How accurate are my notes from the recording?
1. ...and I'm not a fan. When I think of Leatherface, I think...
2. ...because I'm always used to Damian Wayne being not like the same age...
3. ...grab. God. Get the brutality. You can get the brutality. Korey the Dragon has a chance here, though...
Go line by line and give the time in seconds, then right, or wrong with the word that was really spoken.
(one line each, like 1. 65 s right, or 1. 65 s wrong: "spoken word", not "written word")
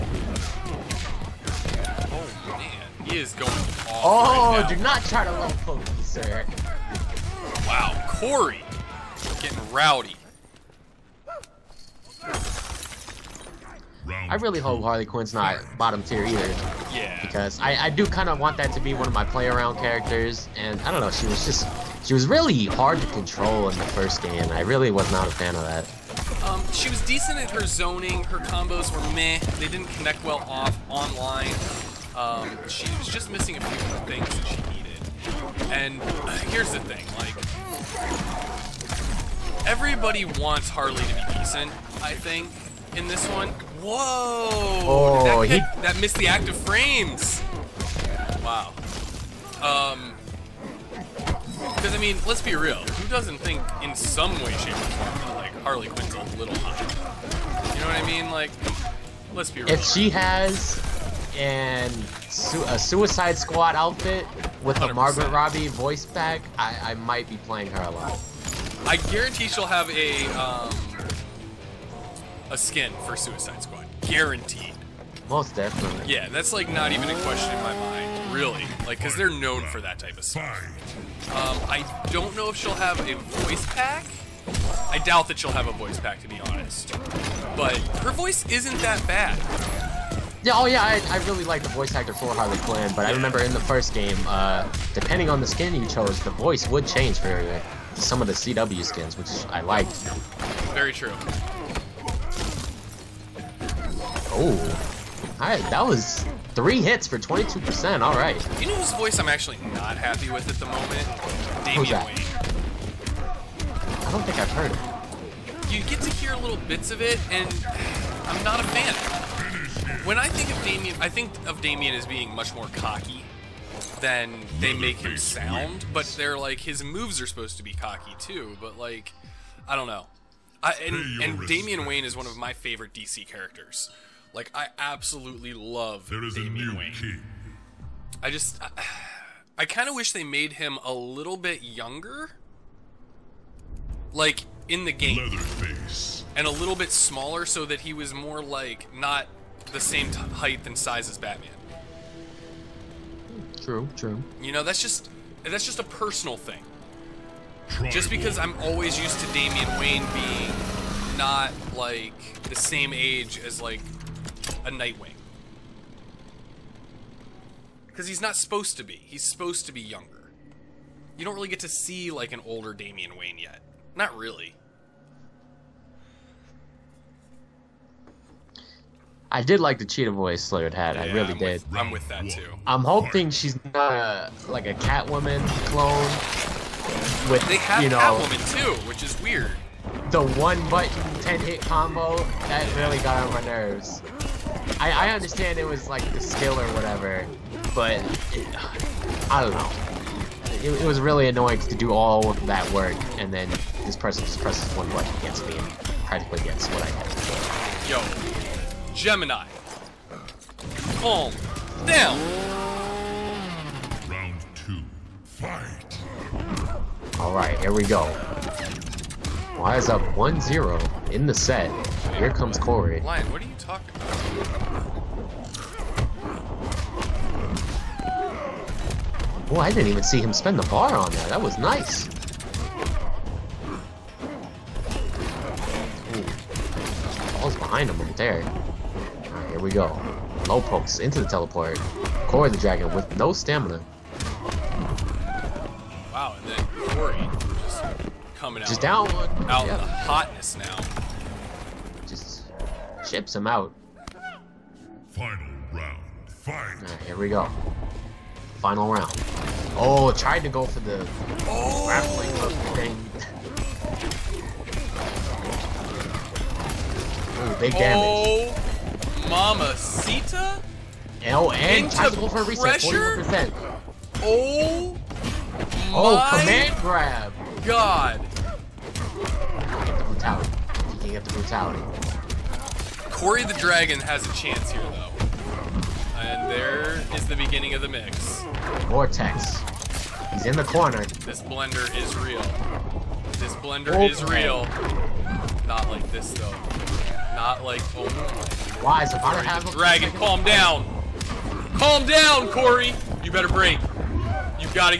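1. 117 s wrong: "Damian", not "Leatherface"
2. 158 s right
3. 276 s right.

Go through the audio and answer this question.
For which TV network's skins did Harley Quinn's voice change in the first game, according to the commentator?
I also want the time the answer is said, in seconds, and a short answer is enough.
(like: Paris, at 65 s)
CW, at 98 s.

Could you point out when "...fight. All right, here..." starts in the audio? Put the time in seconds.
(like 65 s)
215 s.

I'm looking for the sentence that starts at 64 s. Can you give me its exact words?
a Margot Robbie voice pack, I, I might be playing her a lot.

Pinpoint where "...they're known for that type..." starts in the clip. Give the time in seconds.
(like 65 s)
79 s.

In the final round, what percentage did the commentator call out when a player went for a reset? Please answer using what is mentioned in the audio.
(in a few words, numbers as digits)
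40%.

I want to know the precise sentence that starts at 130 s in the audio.
I, and, and Damian Wayne is one of my favorite DC characters.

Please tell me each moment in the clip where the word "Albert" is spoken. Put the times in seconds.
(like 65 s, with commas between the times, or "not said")
not said.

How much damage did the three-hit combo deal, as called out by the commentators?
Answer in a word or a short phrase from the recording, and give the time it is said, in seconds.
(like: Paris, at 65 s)
22%, at 107 s.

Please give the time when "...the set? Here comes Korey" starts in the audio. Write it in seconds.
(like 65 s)
221 s.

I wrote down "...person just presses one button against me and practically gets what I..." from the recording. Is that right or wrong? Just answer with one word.
right.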